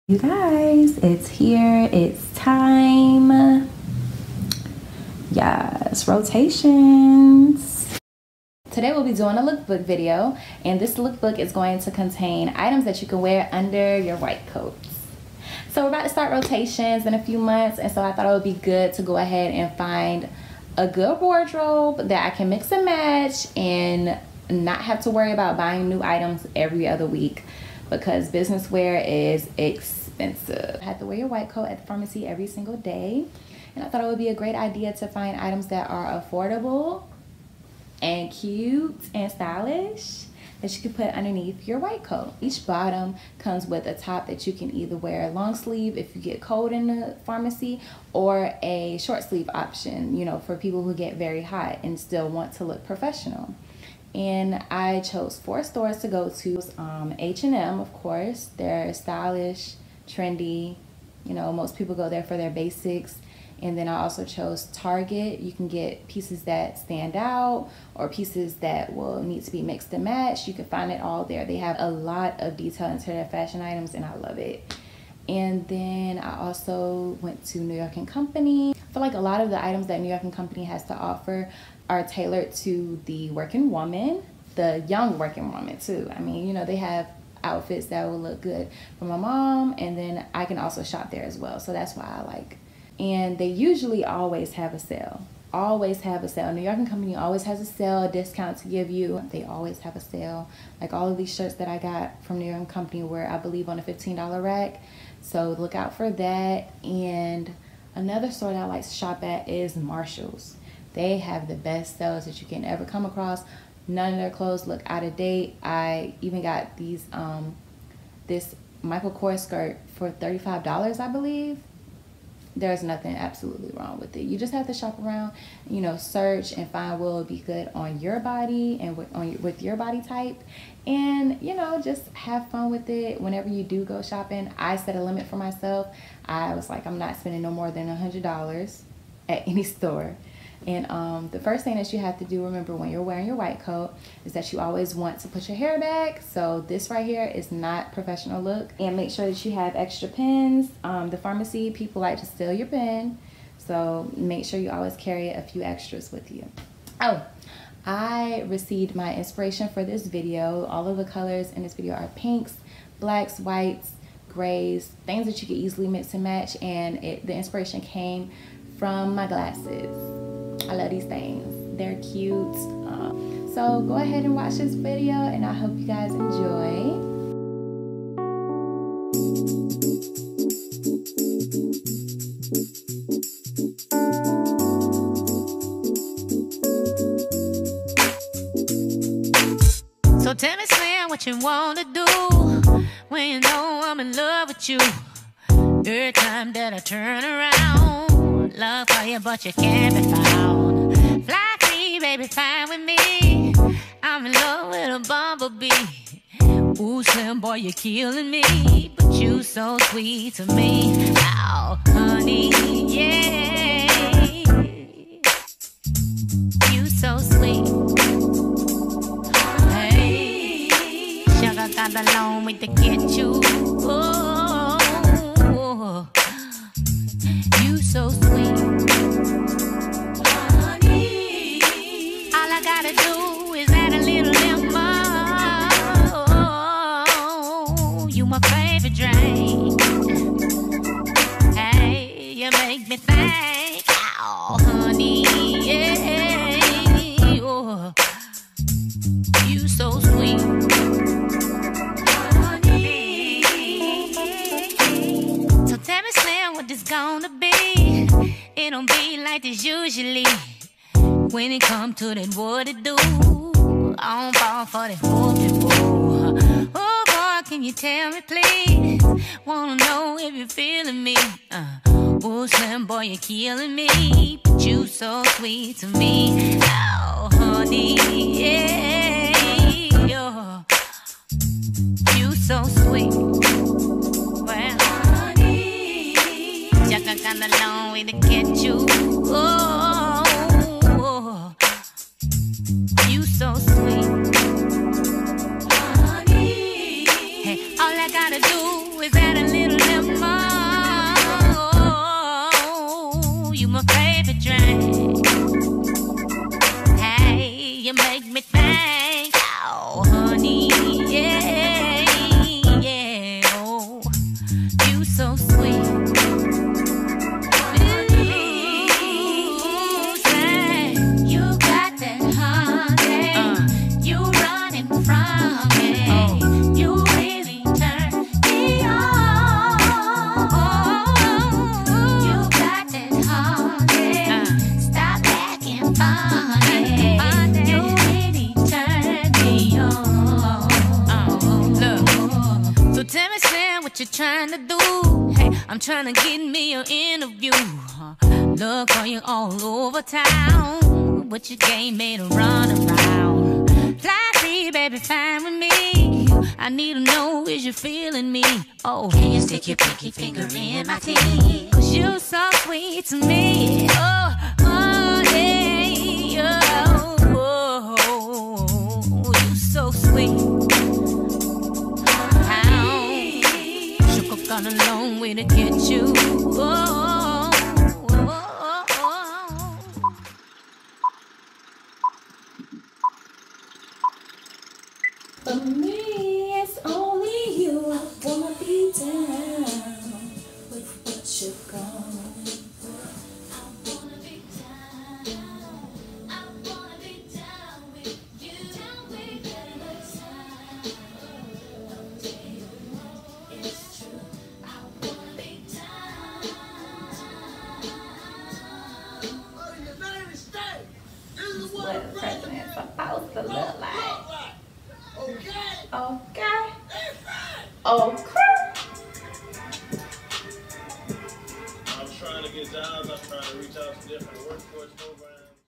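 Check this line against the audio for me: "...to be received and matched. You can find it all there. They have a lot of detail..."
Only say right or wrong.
wrong.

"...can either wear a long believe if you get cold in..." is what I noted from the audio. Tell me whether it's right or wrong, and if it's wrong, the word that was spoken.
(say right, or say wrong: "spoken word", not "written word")
wrong: "sleeve", not "believe".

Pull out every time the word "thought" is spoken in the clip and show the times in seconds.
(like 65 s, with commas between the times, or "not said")
18 s, 33 s.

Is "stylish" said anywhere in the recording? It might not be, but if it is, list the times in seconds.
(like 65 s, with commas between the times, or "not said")
39 s, 58 s.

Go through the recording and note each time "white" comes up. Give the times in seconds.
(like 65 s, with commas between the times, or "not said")
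14 s, 31 s, 41 s, 143 s, 163 s.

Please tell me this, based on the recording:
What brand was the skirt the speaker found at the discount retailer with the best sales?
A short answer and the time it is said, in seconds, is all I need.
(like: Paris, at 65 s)
Michael Kors, at 118 s.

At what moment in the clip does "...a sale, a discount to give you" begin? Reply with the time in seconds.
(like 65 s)
97 s.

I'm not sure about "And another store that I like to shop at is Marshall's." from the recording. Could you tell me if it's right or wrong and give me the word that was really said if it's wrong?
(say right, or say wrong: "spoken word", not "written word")
right.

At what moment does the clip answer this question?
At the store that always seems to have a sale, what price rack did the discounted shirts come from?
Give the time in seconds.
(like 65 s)
103 s.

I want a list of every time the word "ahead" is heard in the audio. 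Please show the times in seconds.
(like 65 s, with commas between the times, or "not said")
19 s, 173 s.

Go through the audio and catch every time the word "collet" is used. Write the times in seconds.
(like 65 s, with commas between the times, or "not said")
not said.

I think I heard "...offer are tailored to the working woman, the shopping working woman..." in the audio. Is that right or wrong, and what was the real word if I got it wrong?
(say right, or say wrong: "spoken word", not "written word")
wrong: "young", not "shopping".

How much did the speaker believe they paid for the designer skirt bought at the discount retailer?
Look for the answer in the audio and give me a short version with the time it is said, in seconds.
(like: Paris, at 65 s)
$35, at 120 s.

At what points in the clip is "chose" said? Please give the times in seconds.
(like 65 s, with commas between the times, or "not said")
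54 s, 64 s.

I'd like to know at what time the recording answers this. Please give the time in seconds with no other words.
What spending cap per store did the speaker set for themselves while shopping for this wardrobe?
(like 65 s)
137 s.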